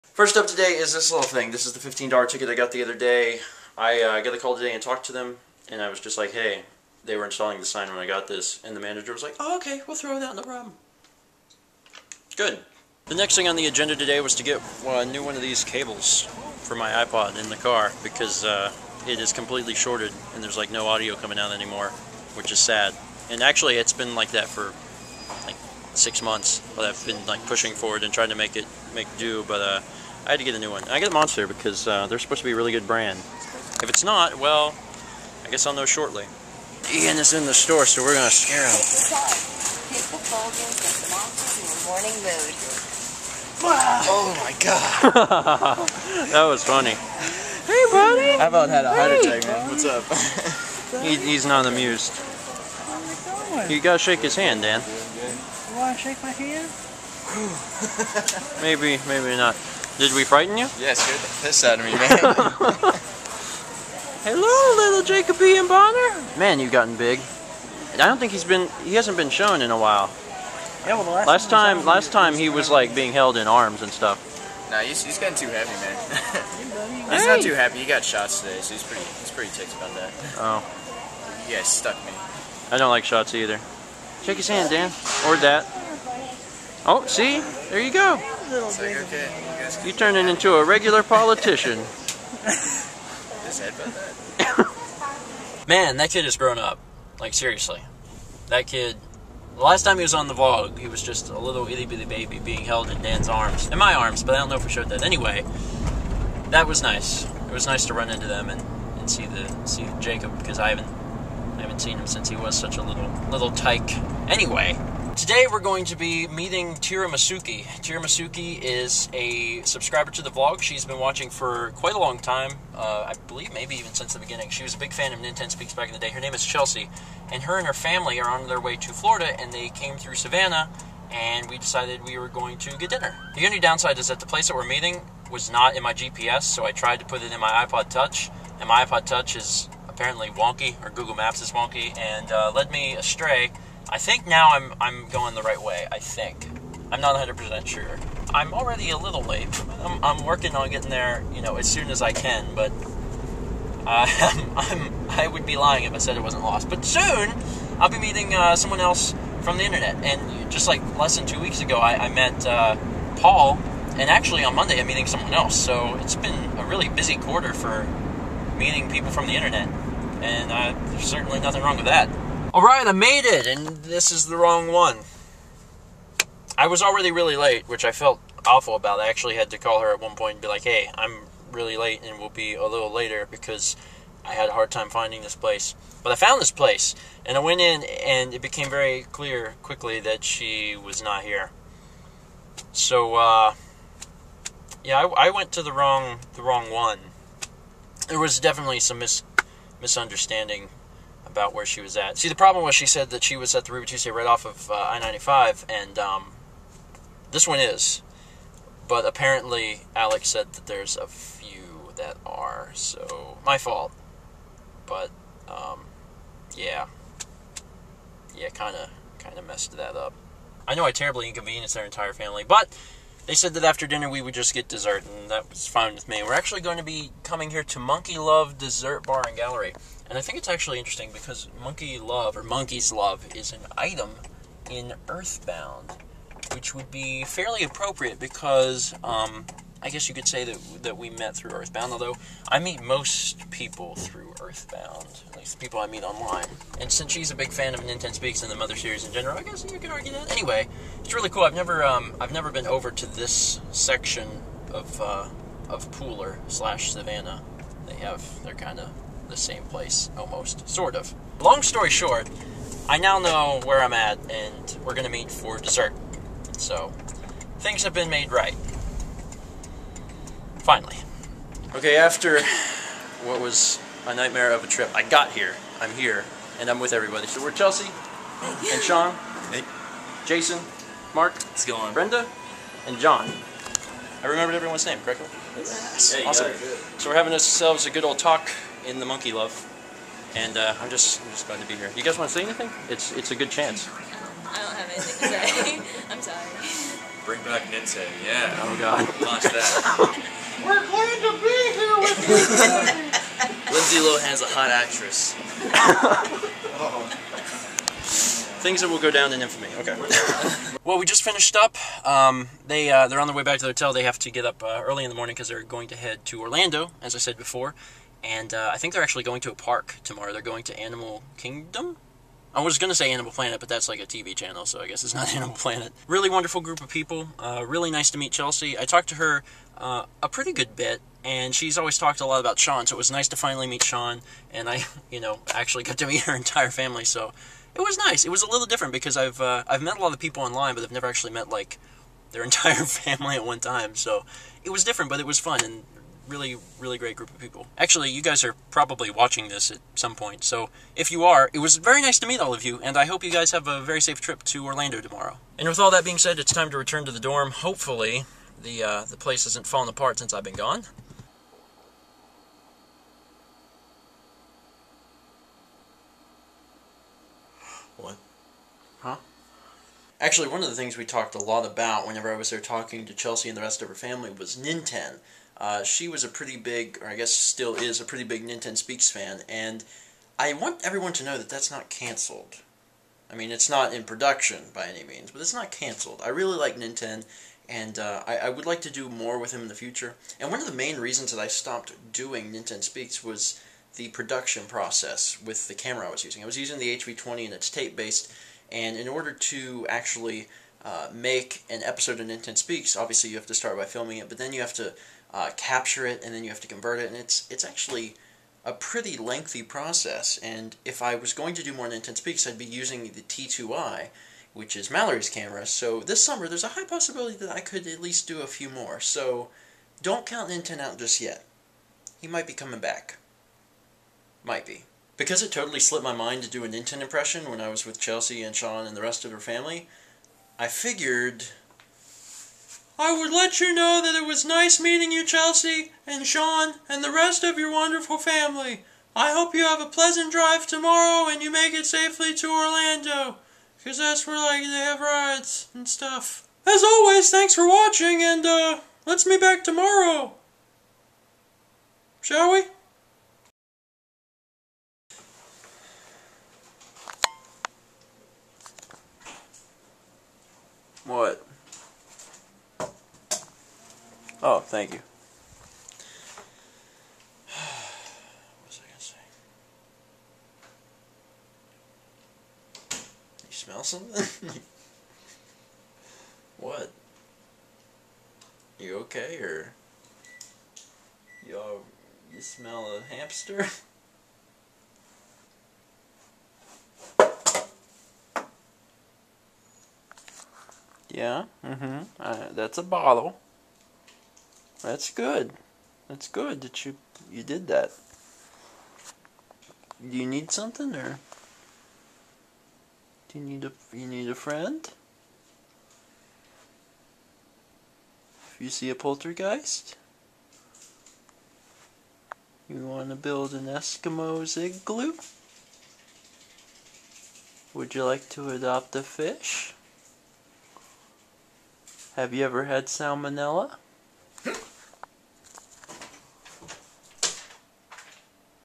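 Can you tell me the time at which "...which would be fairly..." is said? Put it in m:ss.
3:56.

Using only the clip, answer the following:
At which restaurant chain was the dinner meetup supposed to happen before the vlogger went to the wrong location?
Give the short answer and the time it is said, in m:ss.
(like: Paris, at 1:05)
Ruby Tuesday, at 3:23.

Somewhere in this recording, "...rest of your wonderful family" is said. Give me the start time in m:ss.
7:17.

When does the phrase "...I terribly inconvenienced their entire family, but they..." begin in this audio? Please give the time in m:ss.
3:40.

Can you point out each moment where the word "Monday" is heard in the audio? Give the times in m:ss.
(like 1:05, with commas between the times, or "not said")
2:44.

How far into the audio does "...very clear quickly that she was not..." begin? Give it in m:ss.
3:08.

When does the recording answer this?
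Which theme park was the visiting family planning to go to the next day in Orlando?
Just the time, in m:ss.
5:20.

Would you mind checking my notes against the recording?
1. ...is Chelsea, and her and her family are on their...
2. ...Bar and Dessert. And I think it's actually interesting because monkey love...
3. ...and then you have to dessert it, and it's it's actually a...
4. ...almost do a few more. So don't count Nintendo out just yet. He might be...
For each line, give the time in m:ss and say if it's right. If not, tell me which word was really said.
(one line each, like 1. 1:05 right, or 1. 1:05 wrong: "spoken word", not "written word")
1. 2:06 right
2. 3:49 wrong: "Gallery", not "Dessert"
3. 6:46 wrong: "convert", not "dessert"
4. 6:58 wrong: "least", not "almost".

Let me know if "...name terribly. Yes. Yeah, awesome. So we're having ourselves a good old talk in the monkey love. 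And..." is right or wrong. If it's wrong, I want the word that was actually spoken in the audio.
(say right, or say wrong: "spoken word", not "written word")
wrong: "correctly", not "terribly".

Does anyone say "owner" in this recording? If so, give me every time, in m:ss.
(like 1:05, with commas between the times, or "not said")
not said.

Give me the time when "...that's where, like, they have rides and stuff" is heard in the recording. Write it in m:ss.
7:23.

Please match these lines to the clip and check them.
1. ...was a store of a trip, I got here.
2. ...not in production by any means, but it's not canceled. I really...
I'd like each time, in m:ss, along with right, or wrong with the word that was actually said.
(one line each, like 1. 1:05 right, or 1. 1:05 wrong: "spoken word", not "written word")
1. 4:33 wrong: "nightmare", not "store"
2. 6:23 right.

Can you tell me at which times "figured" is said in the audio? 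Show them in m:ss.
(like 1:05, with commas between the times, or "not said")
7:10.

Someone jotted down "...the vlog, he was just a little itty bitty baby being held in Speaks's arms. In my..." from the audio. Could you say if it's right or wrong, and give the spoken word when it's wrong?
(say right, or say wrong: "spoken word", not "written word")
wrong: "Dan", not "Speaks".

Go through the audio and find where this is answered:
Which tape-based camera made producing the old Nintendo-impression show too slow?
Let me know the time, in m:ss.
6:36.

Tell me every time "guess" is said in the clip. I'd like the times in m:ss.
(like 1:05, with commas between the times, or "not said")
0:35, 3:59, 4:09, 5:24, 6:17.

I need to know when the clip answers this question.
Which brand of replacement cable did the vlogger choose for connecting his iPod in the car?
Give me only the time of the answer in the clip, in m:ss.
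0:31.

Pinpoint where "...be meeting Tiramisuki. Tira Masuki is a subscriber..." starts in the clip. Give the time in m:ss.
1:55.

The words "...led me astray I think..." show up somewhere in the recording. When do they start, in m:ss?
2:22.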